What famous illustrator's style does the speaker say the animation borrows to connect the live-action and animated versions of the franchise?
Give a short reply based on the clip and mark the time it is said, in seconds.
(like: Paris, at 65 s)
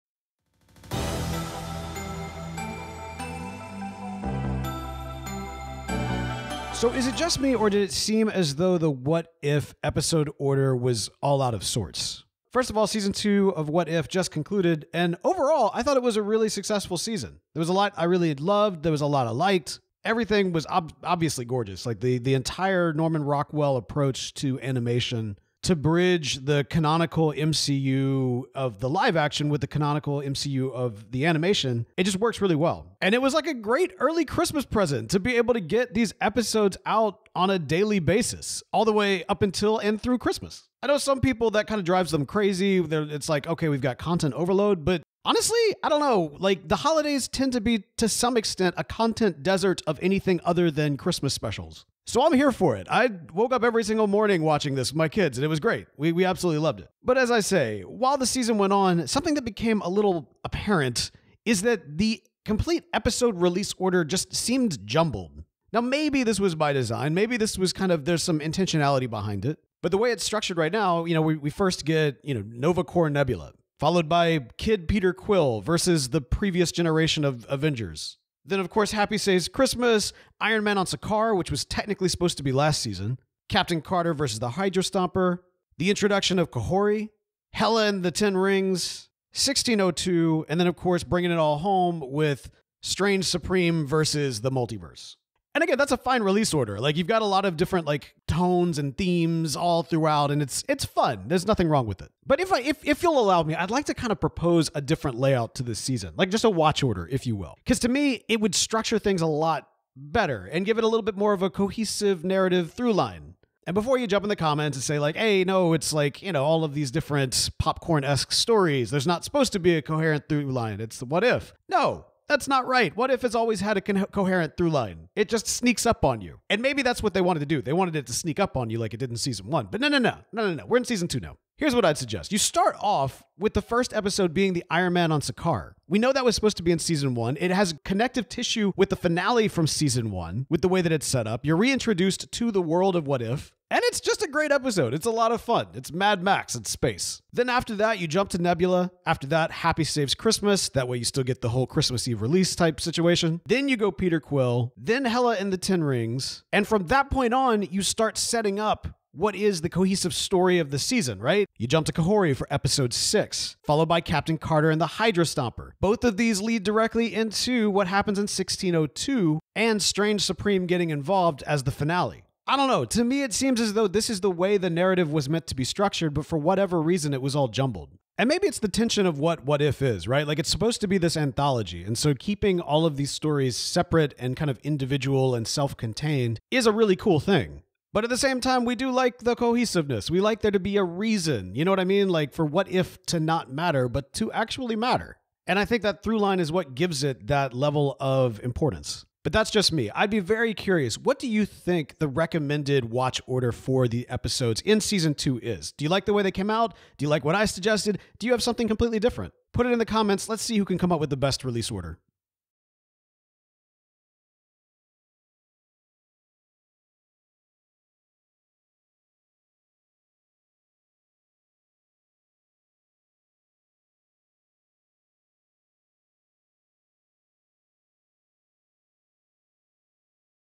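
Norman Rockwell, at 22 s.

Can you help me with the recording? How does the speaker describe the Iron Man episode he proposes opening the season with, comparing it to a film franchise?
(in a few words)
Mad Max in space.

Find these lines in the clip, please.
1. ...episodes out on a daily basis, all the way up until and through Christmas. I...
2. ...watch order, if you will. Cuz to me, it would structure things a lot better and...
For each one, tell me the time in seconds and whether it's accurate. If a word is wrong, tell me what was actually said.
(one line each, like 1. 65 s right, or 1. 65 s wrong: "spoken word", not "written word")
1. 36 s right
2. 106 s right.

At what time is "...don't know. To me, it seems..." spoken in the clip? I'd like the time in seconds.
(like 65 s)
172 s.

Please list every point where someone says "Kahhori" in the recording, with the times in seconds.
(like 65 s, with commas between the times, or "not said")
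86 s, 161 s.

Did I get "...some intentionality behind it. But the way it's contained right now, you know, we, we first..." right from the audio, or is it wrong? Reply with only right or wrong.
wrong.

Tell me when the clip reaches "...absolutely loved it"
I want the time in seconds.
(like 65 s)
56 s.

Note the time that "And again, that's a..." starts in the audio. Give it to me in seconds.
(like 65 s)
95 s.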